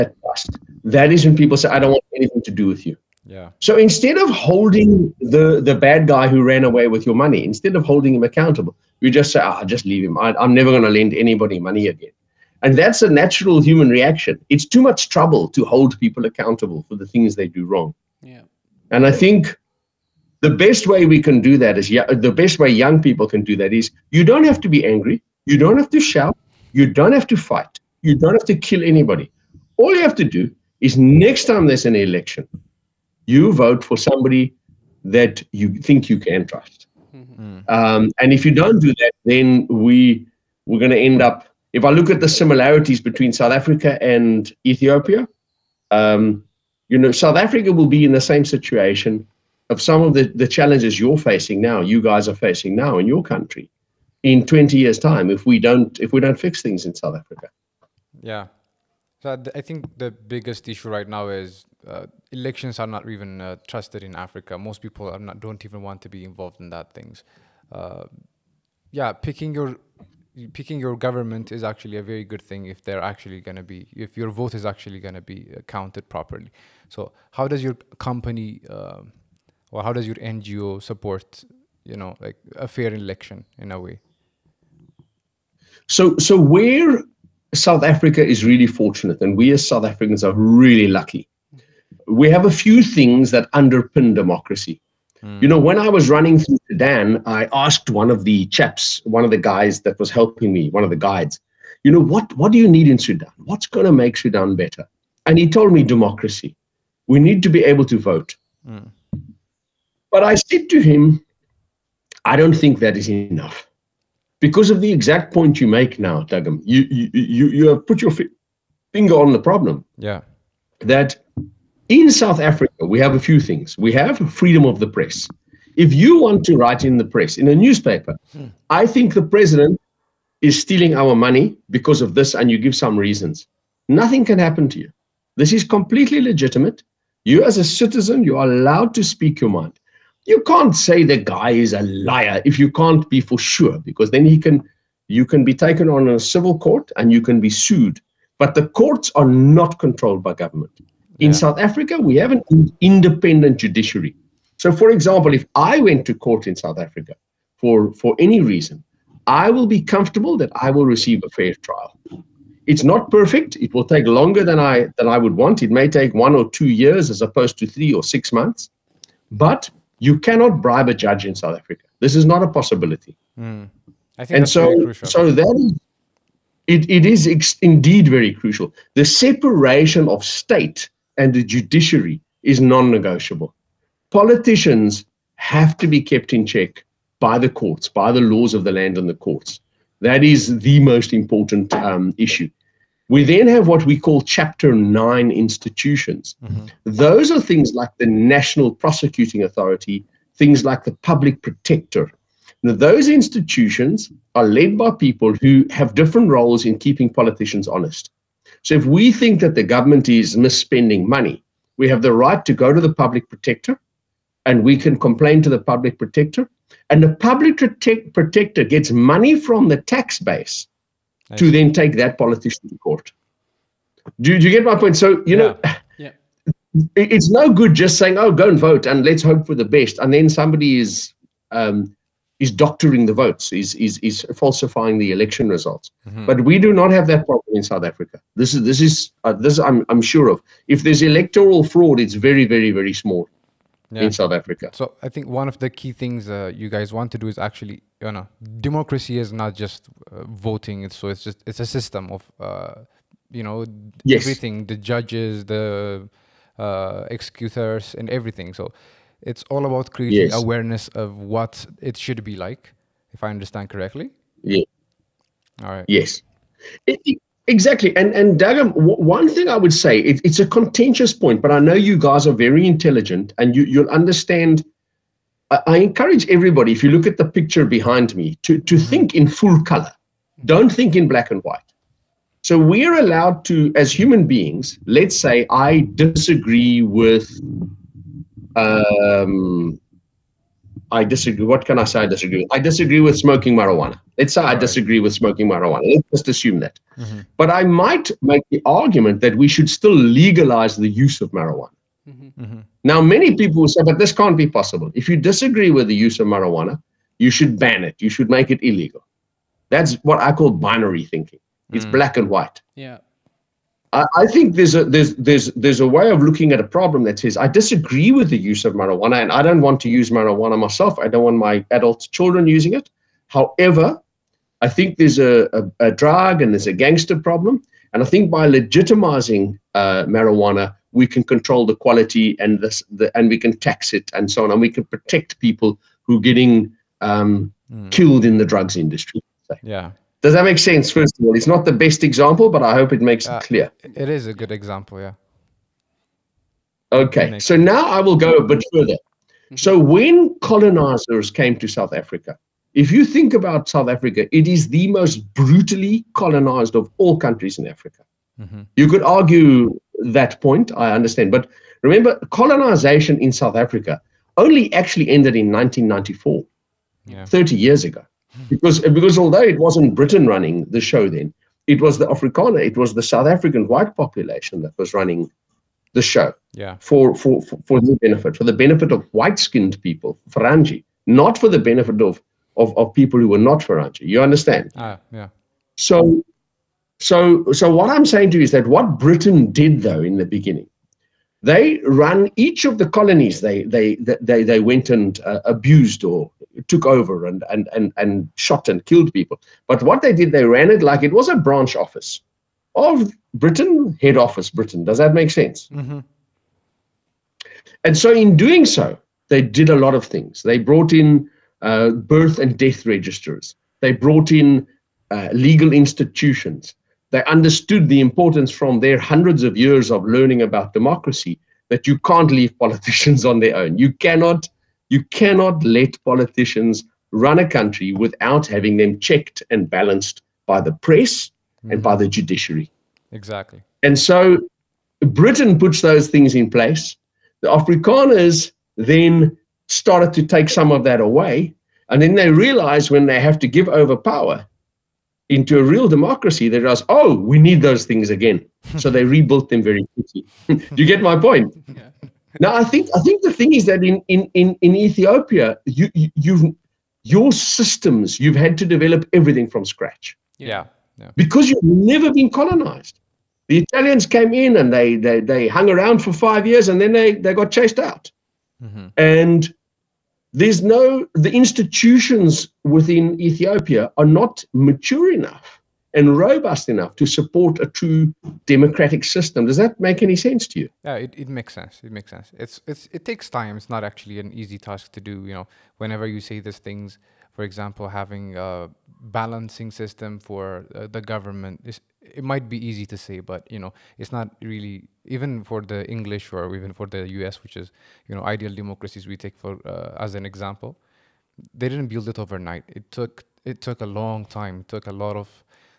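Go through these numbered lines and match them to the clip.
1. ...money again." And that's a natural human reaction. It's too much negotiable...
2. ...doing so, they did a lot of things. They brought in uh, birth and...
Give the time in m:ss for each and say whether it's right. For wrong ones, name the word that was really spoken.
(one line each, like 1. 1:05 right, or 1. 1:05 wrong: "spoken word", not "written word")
1. 0:11 wrong: "trouble", not "negotiable"
2. 6:48 right.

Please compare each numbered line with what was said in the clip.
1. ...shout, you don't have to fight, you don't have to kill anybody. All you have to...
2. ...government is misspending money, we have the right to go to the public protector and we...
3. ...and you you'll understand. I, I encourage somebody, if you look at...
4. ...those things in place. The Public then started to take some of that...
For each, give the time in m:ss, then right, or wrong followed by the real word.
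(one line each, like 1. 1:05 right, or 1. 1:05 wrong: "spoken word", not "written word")
1. 0:26 right
2. 3:29 right
3. 4:33 wrong: "everybody", not "somebody"
4. 7:15 wrong: "Afrikaners", not "Public".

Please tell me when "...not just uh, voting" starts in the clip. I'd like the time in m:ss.
4:09.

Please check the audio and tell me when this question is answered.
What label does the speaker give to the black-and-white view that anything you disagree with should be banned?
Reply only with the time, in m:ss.
5:10.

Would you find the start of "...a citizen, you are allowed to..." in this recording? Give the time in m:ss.
2:17.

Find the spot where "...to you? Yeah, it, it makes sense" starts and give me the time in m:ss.
8:00.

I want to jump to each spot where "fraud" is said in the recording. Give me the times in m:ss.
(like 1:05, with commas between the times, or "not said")
4:01.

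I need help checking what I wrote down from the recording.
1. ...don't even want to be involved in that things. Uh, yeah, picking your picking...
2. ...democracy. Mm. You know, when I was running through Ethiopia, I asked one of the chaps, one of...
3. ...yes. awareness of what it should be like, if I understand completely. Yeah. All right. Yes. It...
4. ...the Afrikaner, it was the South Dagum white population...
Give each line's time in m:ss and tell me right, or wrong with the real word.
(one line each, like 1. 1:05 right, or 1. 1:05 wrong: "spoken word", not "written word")
1. 1:05 right
2. 1:34 wrong: "Sudan", not "Ethiopia"
3. 4:20 wrong: "correctly", not "completely"
4. 6:11 wrong: "African", not "Dagum".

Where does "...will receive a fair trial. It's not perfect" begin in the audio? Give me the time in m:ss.
2:40.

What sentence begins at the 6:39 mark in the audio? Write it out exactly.
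But what they did, they ran it like it was a branch office of Britain, head office Britain.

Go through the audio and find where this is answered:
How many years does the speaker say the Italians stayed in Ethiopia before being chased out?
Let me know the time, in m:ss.
7:46.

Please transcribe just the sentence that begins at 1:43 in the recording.
What's going to make Sudan better?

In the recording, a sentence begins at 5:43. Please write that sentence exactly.
It is a good example, yeah.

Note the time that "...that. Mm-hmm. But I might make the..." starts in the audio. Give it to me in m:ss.
4:56.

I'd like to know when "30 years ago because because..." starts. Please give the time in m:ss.
6:07.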